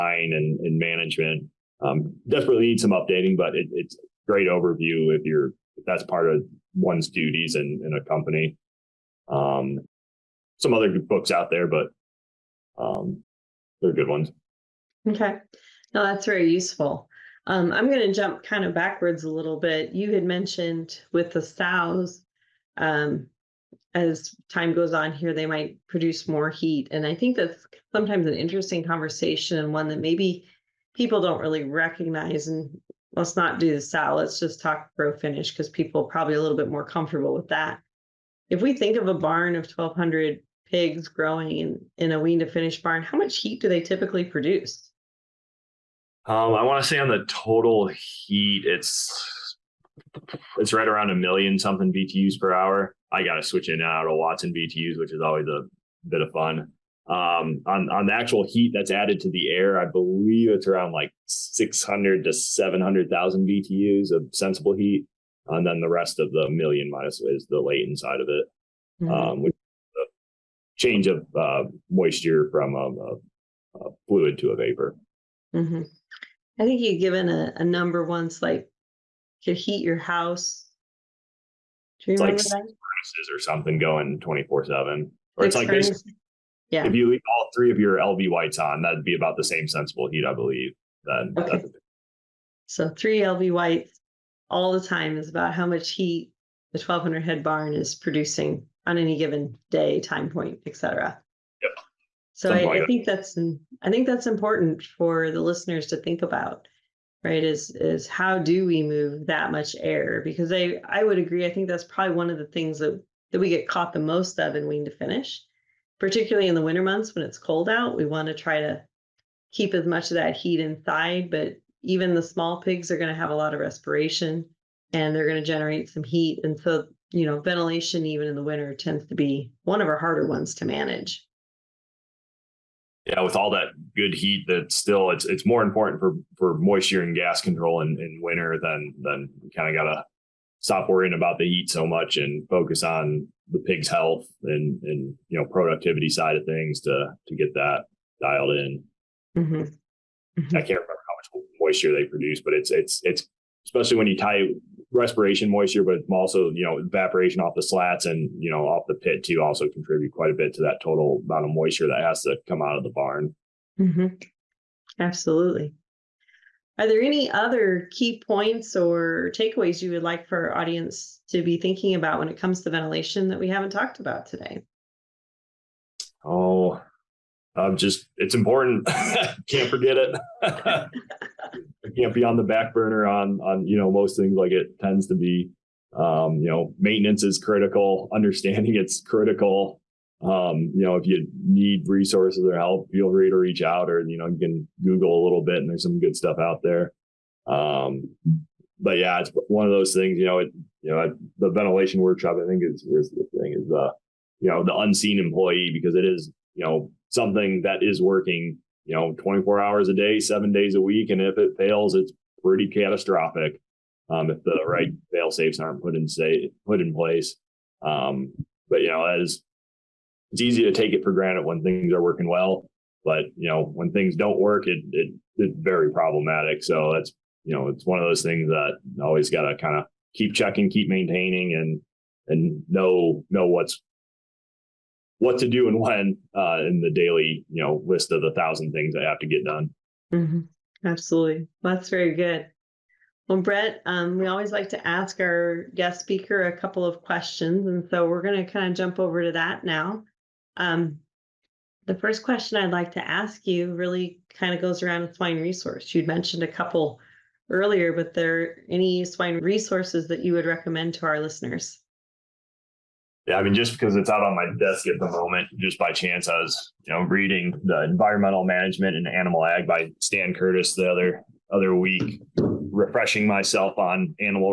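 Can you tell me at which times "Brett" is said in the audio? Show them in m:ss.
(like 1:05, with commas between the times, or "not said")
4:03.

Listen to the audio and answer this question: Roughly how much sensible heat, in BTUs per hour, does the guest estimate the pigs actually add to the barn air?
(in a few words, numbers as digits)
600,000 to 700,000.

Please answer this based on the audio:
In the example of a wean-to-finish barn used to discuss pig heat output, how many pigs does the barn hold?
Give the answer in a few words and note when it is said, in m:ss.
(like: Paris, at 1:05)
1,200, at 0:39.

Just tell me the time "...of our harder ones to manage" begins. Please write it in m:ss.
2:09.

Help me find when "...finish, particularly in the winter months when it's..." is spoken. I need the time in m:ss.
1:54.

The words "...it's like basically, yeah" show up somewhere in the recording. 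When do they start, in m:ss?
1:25.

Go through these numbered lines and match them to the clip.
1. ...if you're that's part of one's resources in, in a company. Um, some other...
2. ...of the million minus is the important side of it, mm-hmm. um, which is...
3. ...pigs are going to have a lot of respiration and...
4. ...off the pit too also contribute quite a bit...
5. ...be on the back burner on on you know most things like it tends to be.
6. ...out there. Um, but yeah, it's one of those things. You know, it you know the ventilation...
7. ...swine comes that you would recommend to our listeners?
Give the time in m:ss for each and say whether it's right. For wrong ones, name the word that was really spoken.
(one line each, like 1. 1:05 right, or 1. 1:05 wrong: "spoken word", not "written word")
1. 0:05 wrong: "duties", not "resources"
2. 1:06 wrong: "latent", not "important"
3. 2:02 right
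4. 2:38 right
5. 3:02 right
6. 3:16 right
7. 4:19 wrong: "resources", not "comes".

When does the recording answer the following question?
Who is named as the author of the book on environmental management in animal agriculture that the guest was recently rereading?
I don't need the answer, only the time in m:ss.
4:30.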